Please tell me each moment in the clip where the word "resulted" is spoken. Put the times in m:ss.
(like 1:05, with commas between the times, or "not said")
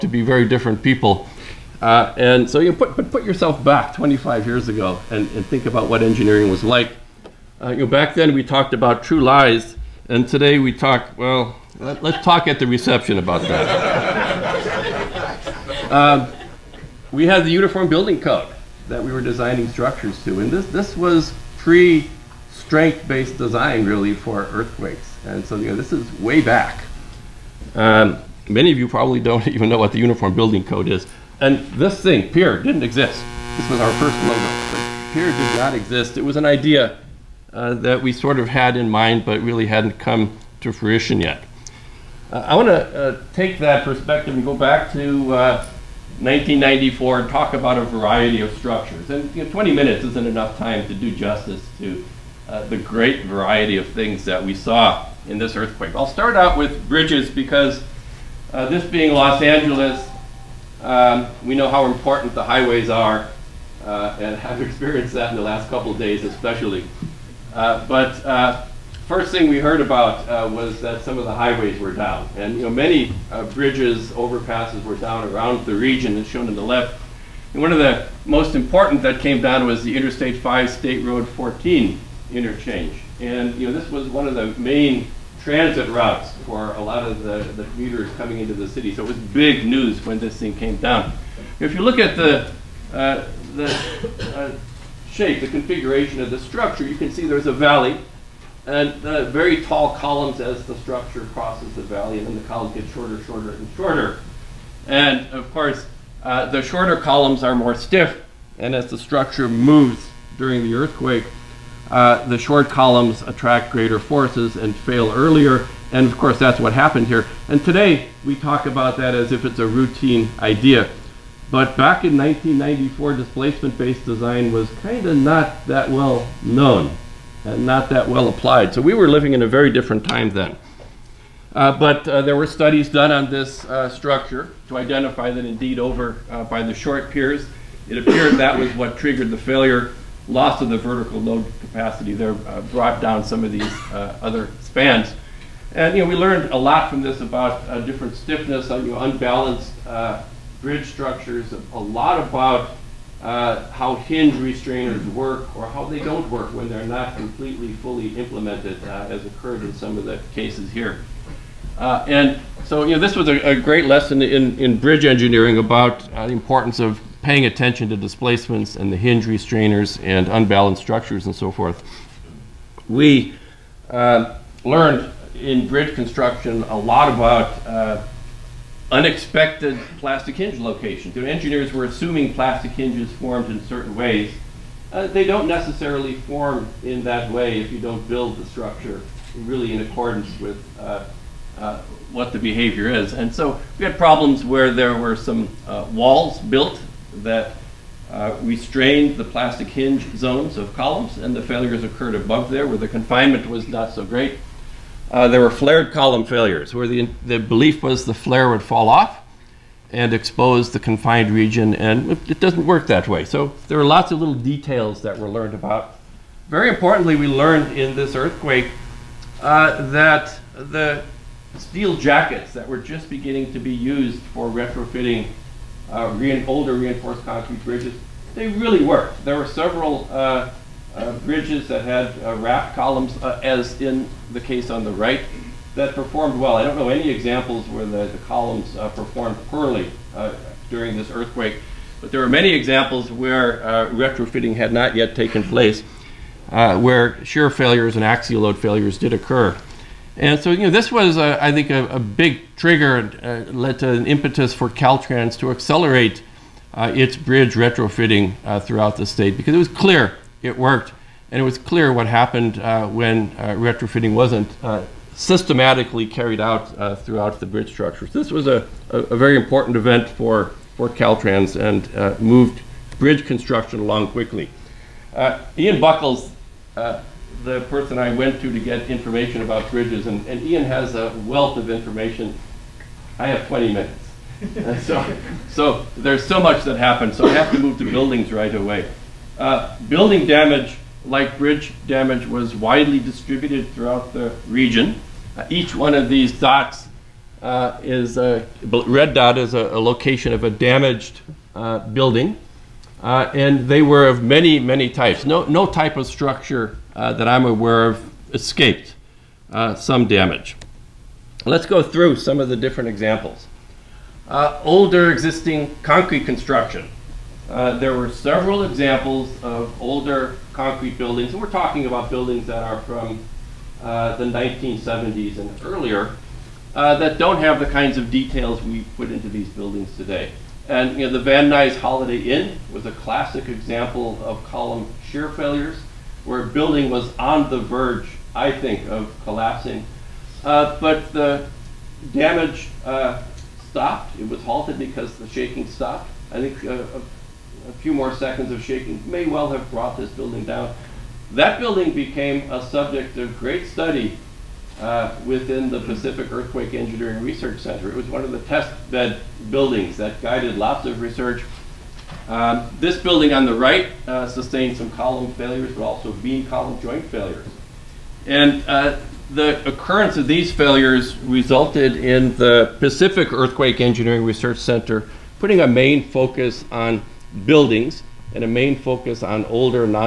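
6:11.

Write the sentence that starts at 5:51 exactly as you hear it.
That building became a subject of great study uh, within the Pacific Earthquake Engineering Research Center.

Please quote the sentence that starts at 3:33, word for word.
So there were lots of little details that were learned about.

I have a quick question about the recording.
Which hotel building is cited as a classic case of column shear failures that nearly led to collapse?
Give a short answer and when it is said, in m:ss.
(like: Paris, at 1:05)
Van Nuys Holiday Inn, at 5:31.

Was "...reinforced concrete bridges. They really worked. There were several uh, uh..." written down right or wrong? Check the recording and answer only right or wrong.
right.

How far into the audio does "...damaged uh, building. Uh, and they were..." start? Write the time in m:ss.
5:00.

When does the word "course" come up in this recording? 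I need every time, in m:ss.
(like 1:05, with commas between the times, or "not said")
1:45, 1:56.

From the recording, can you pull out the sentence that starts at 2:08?
So we were living in a very different time then.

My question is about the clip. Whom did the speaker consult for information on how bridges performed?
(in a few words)
Ian Buckle.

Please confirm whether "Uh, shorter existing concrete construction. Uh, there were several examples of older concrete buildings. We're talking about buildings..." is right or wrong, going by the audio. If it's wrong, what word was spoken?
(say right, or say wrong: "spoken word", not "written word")
wrong: "older", not "shorter".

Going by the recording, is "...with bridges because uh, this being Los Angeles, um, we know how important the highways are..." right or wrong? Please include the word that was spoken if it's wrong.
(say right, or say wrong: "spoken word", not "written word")
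right.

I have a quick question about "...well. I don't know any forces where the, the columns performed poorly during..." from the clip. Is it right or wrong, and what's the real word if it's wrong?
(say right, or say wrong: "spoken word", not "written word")
wrong: "examples", not "forces".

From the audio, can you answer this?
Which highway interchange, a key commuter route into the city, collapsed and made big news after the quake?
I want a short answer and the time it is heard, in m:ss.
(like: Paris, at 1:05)
Interstate 5 State Road 14 interchange, at 1:19.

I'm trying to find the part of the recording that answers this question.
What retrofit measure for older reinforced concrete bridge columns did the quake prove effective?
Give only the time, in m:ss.
3:41.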